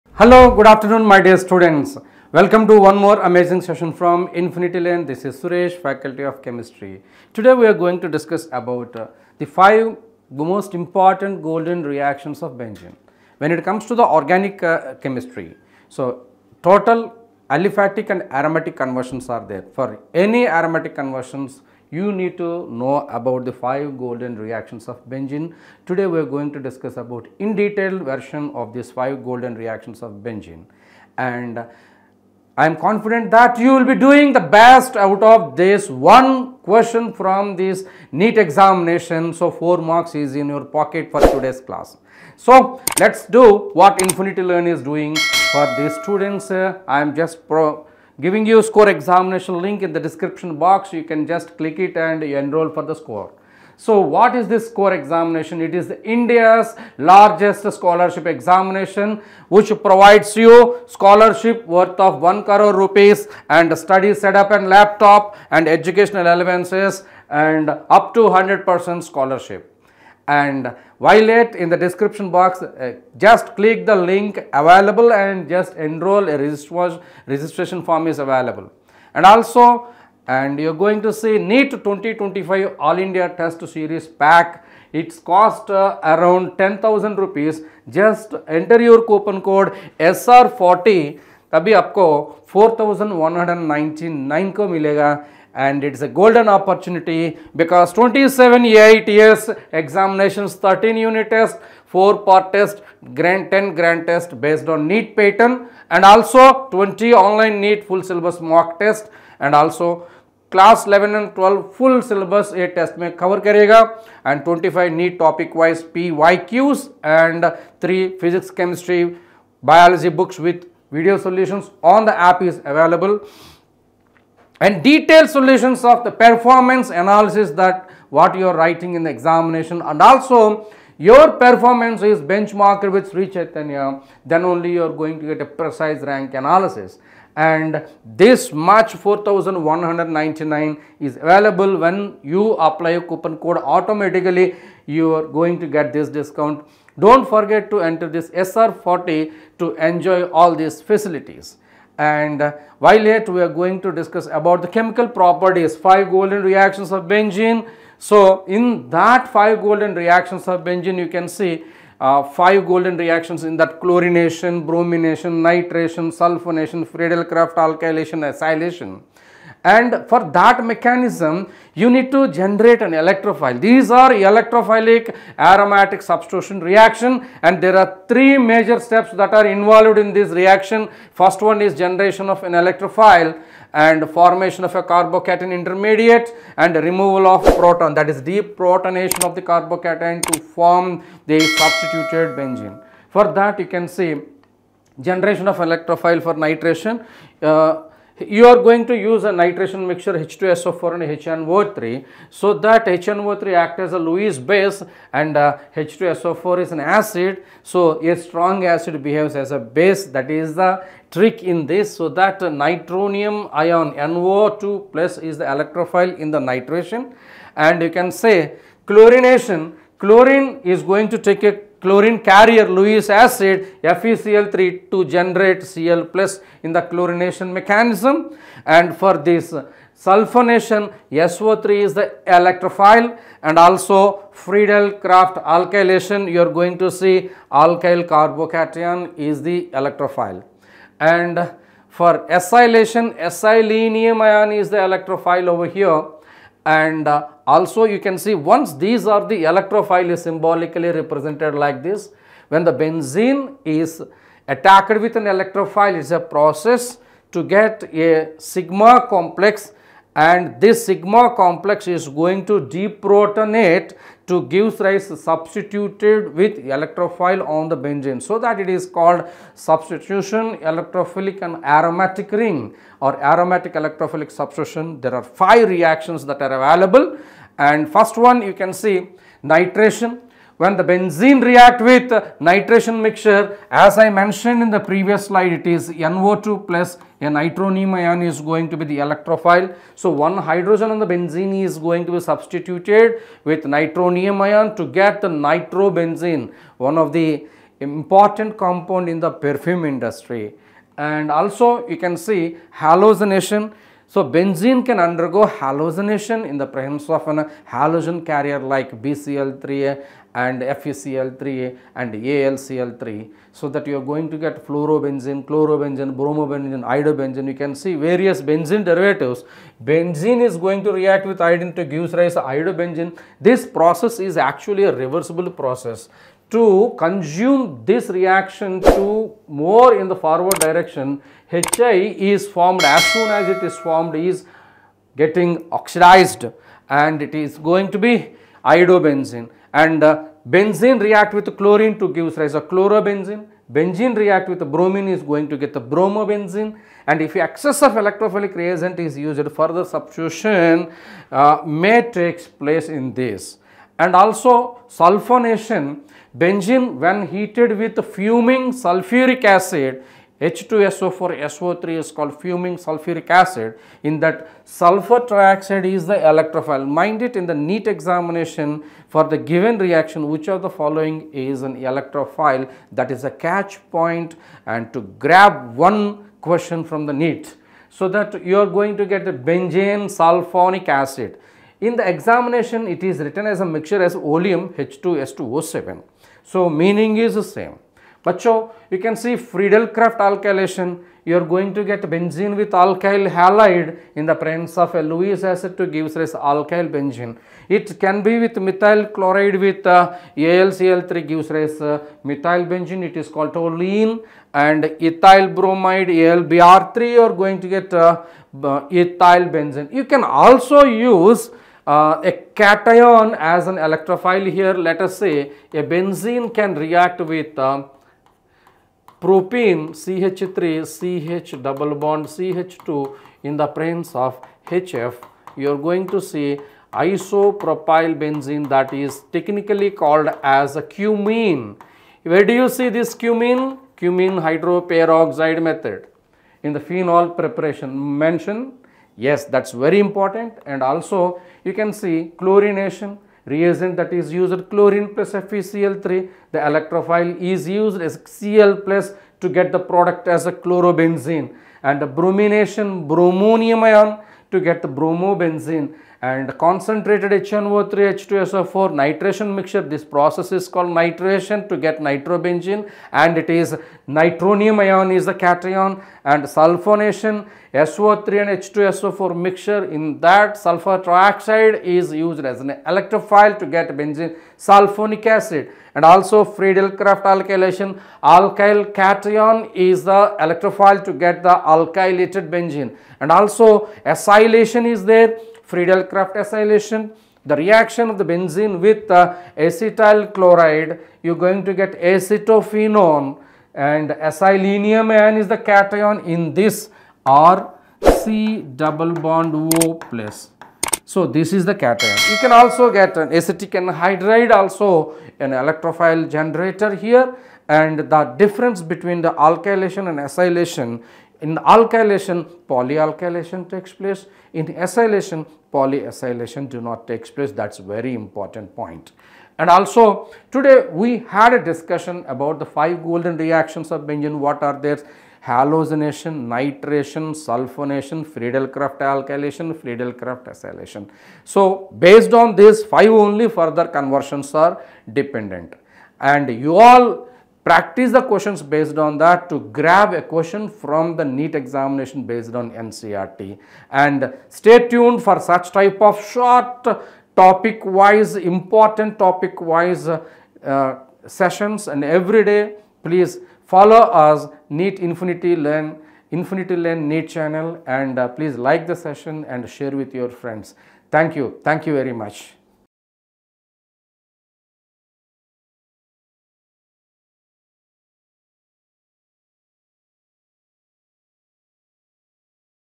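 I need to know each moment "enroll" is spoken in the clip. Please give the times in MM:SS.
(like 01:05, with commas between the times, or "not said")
00:52, 01:15.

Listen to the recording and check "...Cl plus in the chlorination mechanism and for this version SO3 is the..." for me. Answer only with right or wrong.
wrong.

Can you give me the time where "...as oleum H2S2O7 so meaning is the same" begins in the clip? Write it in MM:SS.
06:24.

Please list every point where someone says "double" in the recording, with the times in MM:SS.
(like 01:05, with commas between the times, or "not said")
07:01, 08:18.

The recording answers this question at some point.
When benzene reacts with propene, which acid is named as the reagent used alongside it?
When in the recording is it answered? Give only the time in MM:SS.
07:04.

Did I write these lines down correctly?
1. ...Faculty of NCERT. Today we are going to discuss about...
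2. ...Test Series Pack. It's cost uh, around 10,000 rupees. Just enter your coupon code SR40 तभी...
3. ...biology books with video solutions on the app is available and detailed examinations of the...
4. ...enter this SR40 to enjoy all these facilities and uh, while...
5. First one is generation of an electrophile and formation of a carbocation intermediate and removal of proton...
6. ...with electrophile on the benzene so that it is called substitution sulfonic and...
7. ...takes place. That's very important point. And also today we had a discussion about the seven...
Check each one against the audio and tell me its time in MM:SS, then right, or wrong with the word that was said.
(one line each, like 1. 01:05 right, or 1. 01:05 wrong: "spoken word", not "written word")
1. 00:05 wrong: "Chemistry", not "NCERT"
2. 01:23 right
3. 01:59 wrong: "solutions", not "examinations"
4. 02:27 right
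5. 03:01 right
6. 04:26 wrong: "electrophilic", not "sulfonic"
7. 08:37 wrong: "five", not "seven".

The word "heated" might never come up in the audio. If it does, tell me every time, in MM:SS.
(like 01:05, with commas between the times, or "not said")
05:57.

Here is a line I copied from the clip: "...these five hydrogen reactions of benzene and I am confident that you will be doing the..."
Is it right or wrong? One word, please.
wrong.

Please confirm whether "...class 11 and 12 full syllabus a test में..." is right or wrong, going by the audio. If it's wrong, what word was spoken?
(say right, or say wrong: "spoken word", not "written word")
right.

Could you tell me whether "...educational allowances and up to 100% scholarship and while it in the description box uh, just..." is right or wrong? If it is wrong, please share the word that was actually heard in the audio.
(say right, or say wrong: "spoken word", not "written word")
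right.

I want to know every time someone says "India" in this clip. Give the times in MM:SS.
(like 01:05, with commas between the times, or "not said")
00:56, 01:22.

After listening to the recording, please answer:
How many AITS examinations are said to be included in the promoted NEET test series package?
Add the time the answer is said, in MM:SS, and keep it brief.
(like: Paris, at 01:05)
27, at 01:37.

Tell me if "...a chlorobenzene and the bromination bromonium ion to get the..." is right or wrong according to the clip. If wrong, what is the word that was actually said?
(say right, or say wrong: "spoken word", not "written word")
right.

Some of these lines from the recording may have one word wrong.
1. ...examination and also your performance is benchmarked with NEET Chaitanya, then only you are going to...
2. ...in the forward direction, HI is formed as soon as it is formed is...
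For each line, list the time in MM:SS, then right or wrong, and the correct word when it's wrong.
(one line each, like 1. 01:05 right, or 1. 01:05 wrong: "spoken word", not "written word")
1. 02:09 wrong: "Sri", not "NEET"
2. 05:29 right.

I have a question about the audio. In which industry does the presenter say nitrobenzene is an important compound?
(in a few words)
perfume industry.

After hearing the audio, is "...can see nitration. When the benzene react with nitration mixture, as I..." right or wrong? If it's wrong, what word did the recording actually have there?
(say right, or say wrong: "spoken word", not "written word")
right.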